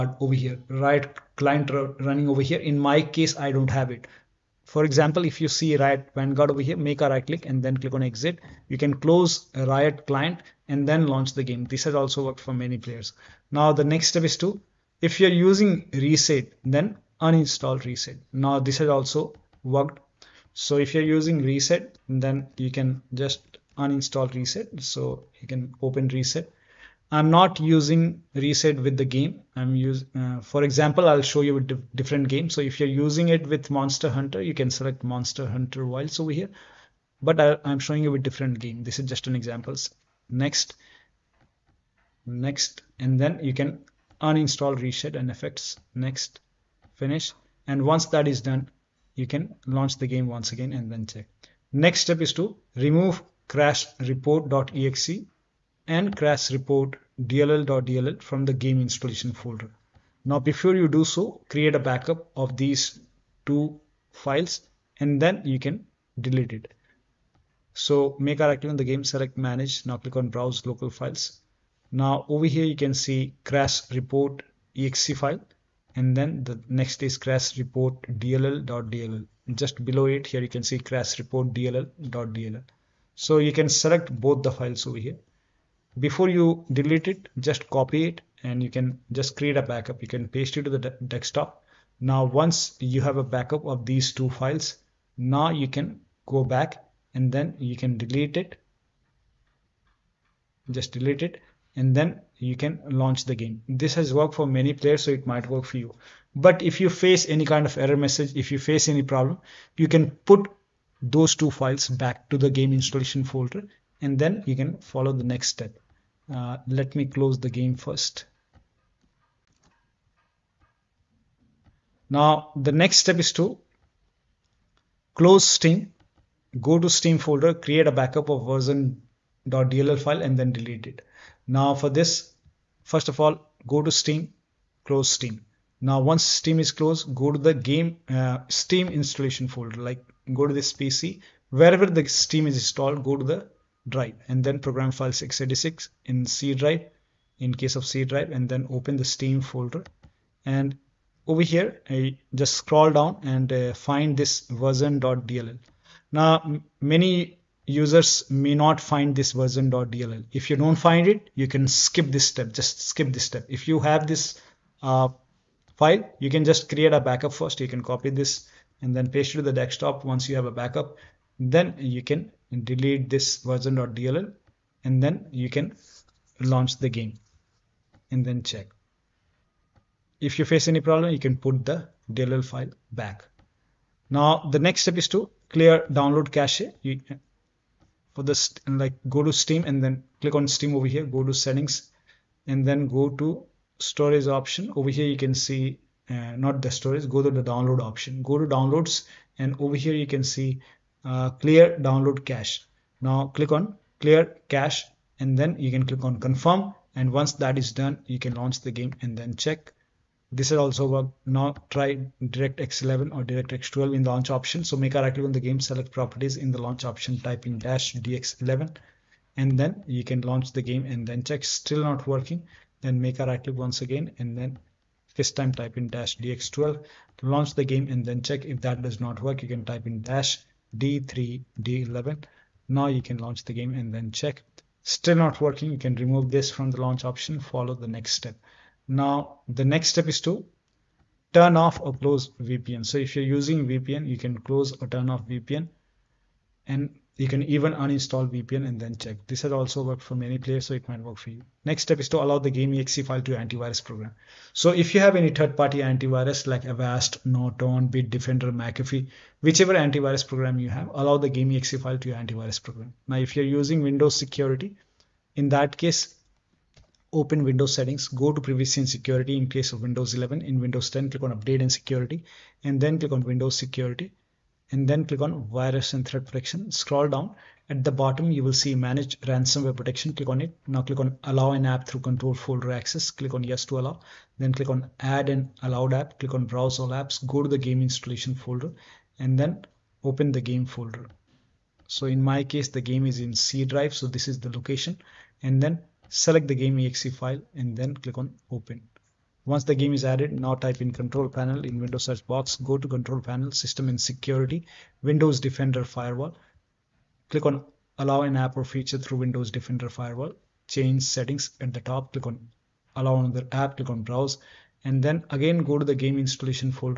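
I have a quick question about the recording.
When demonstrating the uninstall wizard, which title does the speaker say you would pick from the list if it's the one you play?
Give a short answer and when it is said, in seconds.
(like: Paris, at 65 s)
Monster Hunter Wilds, at 35 s.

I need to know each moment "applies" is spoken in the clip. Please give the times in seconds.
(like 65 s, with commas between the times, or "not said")
not said.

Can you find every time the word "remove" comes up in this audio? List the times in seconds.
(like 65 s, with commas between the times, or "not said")
52 s, 235 s.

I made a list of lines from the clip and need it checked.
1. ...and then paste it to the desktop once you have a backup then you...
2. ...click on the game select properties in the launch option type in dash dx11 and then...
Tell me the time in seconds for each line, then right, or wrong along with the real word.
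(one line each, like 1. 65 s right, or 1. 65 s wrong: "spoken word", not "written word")
1. 168 s right
2. 215 s right.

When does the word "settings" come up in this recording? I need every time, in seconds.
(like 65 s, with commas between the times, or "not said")
191 s, 267 s, 311 s.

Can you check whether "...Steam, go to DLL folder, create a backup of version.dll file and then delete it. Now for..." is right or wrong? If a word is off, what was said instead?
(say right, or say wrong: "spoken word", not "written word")
wrong: "Steam", not "DLL".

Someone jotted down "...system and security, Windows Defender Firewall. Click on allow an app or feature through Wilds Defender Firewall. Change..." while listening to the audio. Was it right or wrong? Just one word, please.
wrong.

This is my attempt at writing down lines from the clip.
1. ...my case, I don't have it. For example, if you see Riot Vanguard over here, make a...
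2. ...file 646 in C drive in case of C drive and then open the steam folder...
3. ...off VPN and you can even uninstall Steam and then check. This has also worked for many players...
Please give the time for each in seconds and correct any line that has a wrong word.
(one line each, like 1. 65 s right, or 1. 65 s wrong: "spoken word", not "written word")
1. 2 s right
2. 144 s wrong: "686", not "646"
3. 245 s wrong: "VPN", not "Steam".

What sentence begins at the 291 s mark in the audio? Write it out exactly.
So in my case, the game is in C drive.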